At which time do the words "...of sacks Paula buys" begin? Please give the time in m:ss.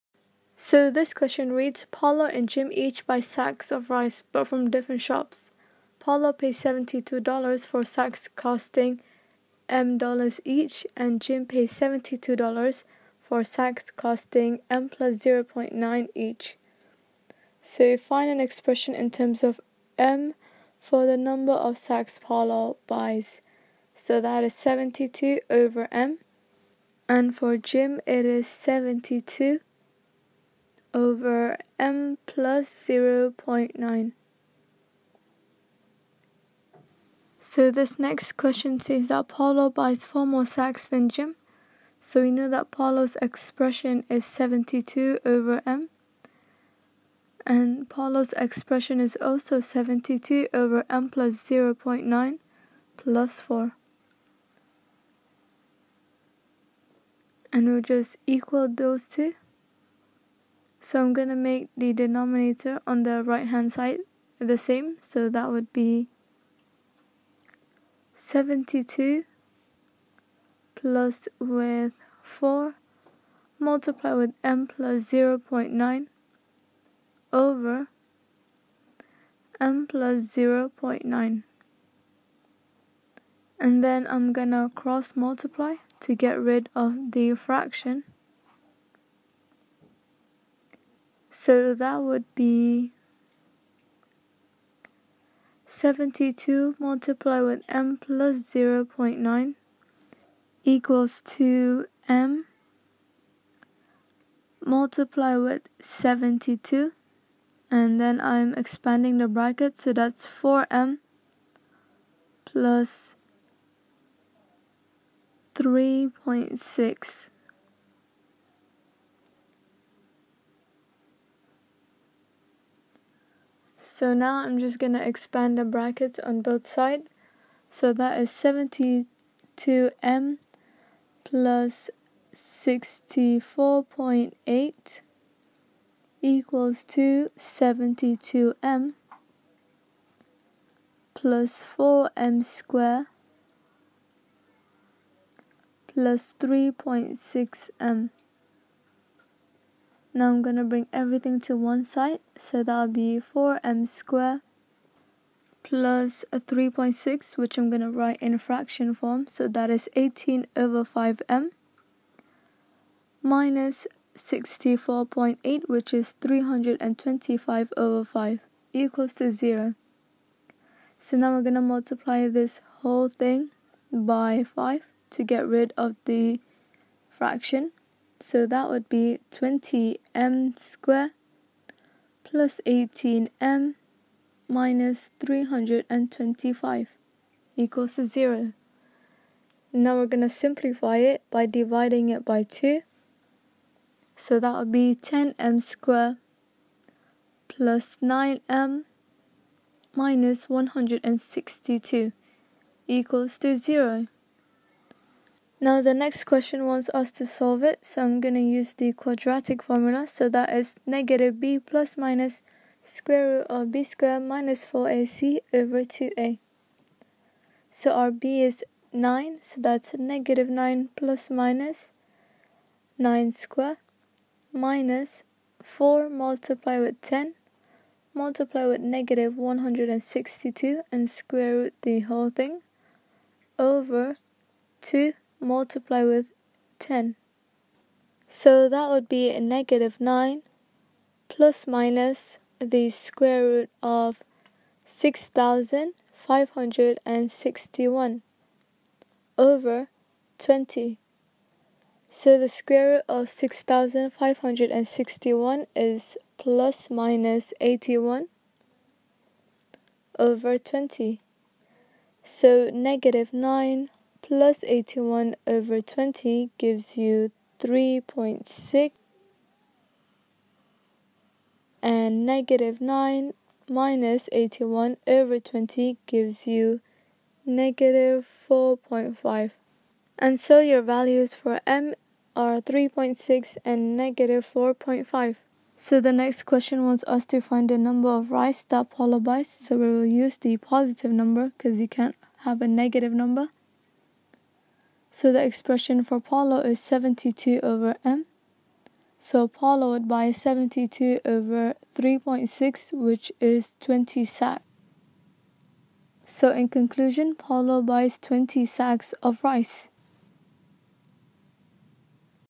0:21.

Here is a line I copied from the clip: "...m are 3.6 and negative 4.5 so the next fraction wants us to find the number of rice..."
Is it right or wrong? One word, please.
wrong.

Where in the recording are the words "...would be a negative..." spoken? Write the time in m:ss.
3:58.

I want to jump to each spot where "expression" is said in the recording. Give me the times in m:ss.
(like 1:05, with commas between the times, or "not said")
0:18, 0:43, 0:48, 4:55.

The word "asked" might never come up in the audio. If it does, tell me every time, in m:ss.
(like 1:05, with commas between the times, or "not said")
not said.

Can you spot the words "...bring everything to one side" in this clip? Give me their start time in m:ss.
2:30.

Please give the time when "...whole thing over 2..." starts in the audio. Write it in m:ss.
3:52.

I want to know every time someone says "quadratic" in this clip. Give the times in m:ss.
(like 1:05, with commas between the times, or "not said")
3:28.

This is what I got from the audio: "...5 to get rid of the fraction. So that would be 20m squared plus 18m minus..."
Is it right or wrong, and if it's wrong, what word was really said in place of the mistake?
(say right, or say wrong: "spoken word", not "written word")
right.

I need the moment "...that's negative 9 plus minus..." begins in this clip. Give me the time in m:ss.
3:39.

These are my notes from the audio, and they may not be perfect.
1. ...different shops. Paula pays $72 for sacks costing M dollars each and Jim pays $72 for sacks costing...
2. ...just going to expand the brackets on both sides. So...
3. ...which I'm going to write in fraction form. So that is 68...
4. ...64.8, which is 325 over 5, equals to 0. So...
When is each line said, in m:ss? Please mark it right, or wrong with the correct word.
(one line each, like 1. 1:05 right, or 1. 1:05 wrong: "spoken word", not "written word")
1. 0:04 right
2. 2:04 right
3. 2:37 wrong: "18", not "68"
4. 2:44 right.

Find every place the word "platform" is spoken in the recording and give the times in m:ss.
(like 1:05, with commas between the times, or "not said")
not said.